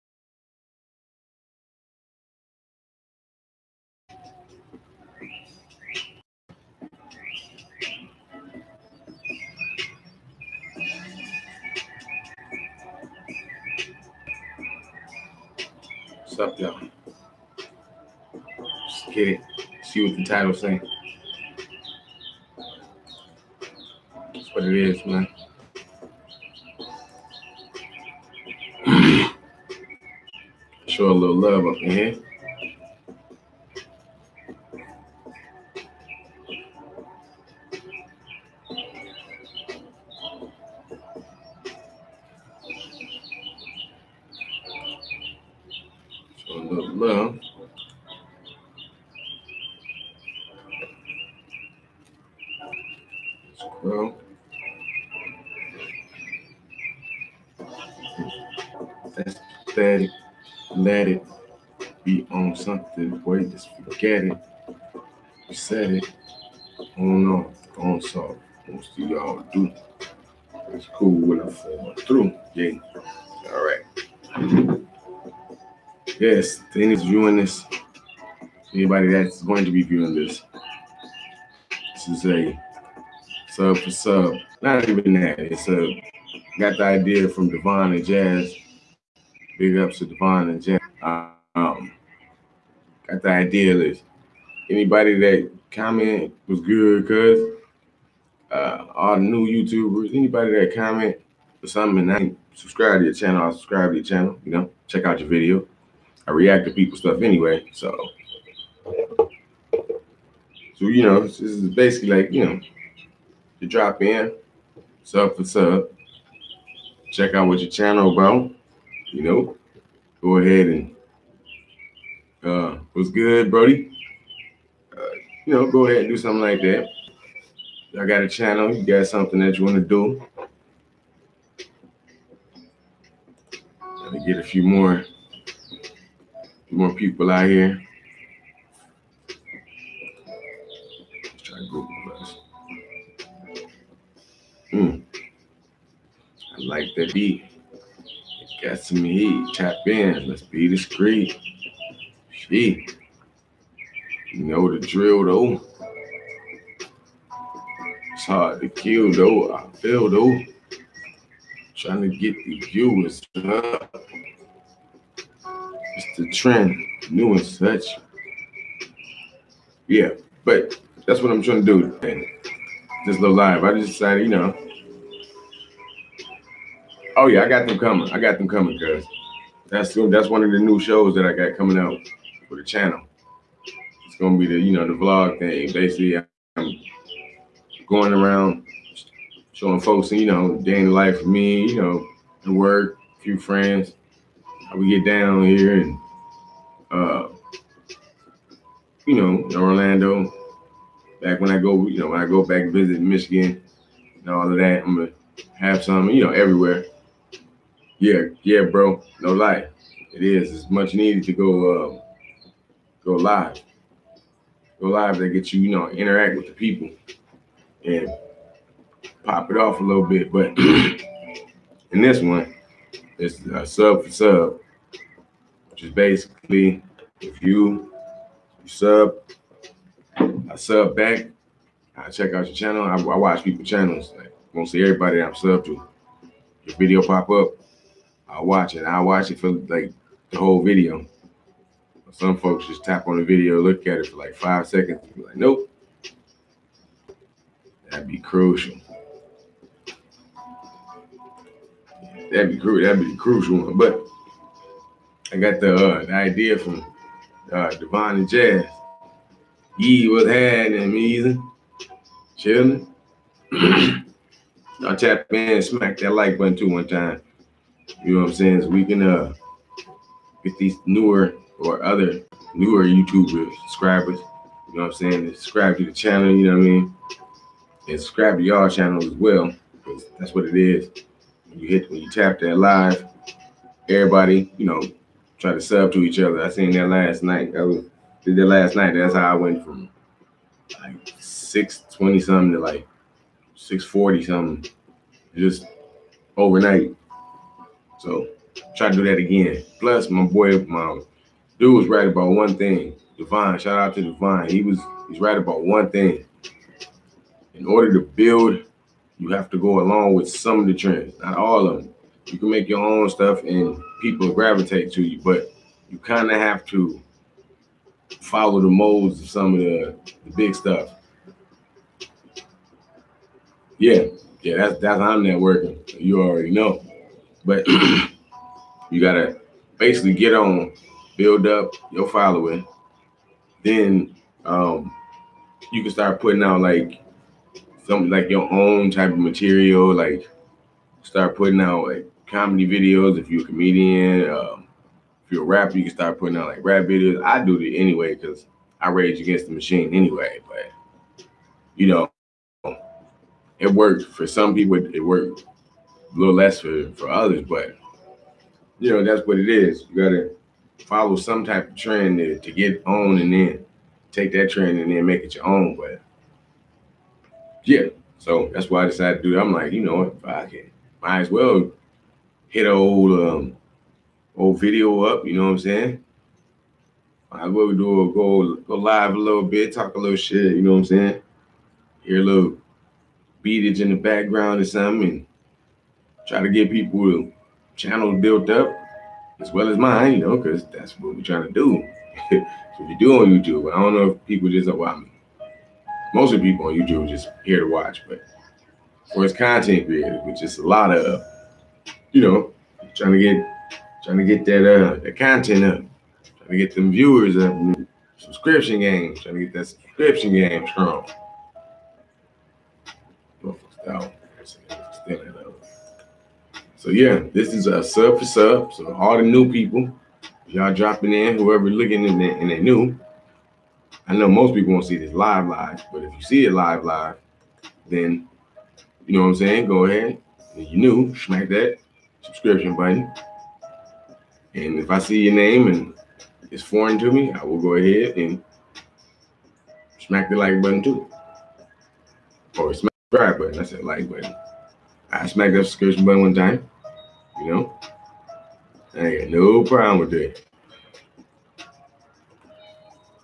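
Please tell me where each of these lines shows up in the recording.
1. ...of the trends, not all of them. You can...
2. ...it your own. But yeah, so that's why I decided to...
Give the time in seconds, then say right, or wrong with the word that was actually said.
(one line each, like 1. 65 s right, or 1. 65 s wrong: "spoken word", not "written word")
1. 310 s right
2. 365 s right.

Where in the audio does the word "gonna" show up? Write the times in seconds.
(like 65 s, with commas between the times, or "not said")
184 s, 204 s.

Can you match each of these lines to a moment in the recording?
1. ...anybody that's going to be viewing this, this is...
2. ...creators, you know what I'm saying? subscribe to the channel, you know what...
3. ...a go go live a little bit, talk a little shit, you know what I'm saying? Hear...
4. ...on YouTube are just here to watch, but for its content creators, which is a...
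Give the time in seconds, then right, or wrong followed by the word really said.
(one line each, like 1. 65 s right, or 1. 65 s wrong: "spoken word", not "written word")
1. 78 s right
2. 273 s wrong: "subscribers", not "creators"
3. 378 s right
4. 396 s right.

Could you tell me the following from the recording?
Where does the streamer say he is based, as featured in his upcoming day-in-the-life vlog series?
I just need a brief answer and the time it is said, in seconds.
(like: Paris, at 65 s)
Orlando, at 199 s.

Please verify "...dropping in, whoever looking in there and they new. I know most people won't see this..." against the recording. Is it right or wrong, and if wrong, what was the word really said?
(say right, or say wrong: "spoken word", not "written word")
right.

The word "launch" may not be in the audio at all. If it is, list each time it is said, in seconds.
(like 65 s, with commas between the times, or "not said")
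not said.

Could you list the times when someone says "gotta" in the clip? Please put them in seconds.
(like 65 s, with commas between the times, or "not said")
328 s, 360 s.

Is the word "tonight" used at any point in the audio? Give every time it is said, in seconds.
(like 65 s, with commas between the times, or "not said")
not said.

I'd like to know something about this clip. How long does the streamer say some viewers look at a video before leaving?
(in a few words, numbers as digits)
5 seconds.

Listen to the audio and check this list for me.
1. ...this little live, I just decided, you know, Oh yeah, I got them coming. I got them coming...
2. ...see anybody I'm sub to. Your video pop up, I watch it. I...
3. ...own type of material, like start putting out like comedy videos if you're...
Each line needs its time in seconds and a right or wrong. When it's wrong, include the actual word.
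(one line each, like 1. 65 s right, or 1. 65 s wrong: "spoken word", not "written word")
1. 173 s right
2. 234 s wrong: "everybody", not "anybody"
3. 338 s right.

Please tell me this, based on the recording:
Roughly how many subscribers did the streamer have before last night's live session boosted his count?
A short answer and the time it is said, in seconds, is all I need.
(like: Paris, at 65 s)
620, at 291 s.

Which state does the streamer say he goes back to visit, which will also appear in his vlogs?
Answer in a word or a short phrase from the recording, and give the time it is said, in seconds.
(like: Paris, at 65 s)
Michigan, at 202 s.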